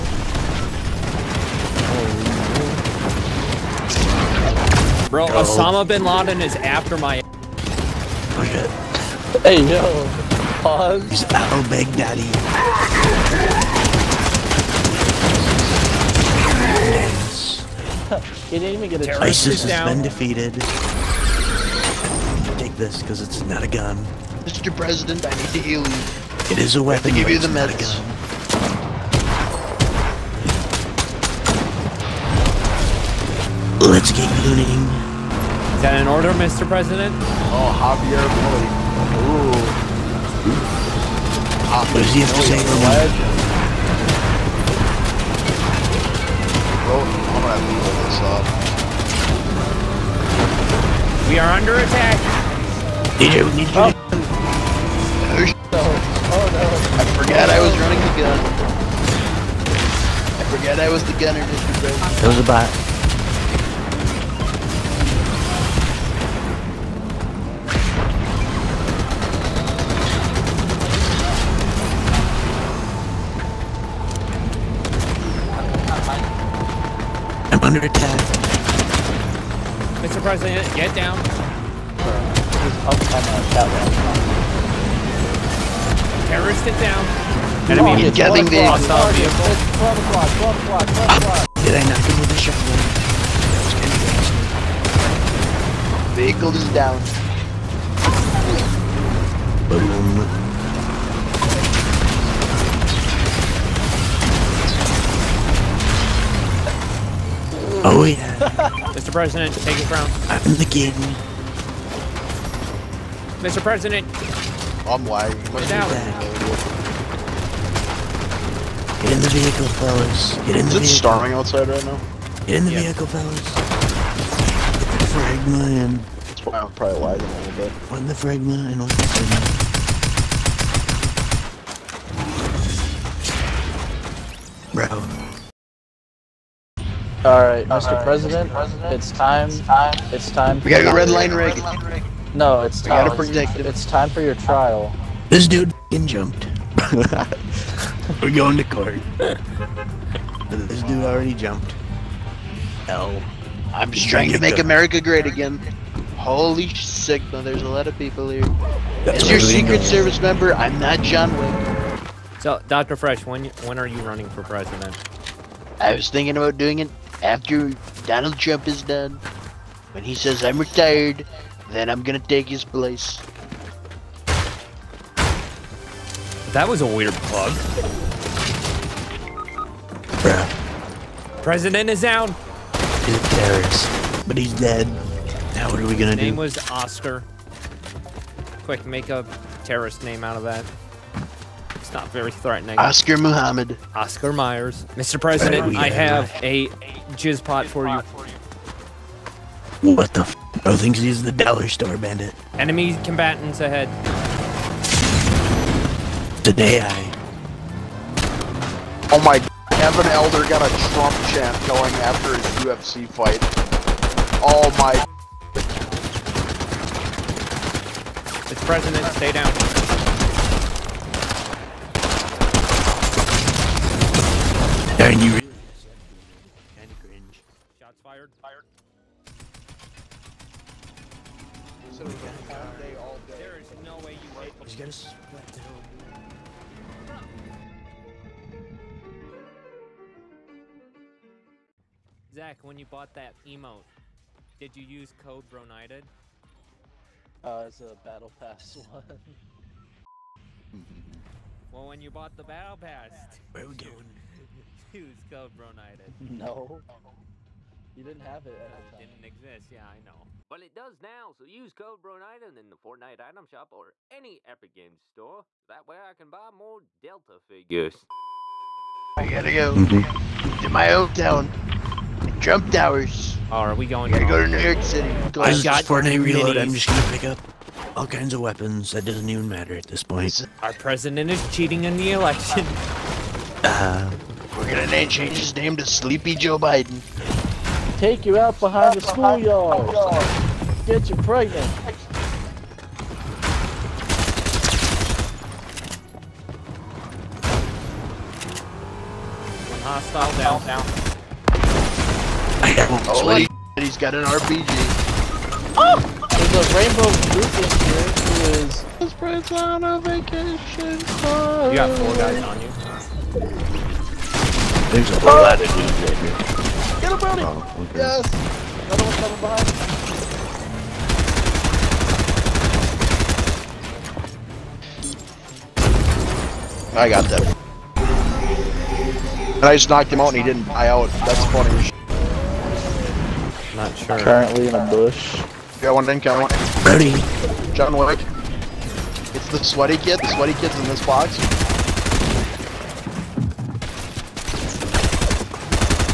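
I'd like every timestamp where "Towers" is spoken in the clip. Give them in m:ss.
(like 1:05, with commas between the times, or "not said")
4:32.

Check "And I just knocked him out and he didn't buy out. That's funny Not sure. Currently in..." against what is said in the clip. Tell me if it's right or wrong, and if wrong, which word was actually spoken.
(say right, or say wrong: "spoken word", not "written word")
right.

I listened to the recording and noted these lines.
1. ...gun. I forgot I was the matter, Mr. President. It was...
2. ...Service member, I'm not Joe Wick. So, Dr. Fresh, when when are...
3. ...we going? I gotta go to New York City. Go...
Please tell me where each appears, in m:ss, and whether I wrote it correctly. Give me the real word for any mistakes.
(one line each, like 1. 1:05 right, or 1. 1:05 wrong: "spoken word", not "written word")
1. 0:58 wrong: "gunner", not "matter"
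2. 2:39 wrong: "John", not "Joe"
3. 4:33 right.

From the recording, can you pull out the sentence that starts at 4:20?
But it does now, so use code BroNited in the Fortnite item shop or any Epic Games store.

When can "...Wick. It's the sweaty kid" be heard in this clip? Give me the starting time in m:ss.
5:37.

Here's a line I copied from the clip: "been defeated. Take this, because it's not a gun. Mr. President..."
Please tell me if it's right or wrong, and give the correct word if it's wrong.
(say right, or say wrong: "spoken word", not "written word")
right.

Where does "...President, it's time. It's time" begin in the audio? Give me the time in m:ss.
2:18.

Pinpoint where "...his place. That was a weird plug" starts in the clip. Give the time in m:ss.
2:52.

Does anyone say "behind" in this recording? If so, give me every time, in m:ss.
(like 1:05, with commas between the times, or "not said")
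4:48, 5:19.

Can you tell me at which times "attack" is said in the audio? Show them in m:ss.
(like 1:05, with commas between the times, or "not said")
0:51, 1:17.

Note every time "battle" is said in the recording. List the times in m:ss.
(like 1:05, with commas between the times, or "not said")
4:08, 4:12.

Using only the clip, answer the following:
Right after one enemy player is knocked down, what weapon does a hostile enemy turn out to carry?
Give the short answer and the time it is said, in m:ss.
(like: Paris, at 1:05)
RPG, at 5:04.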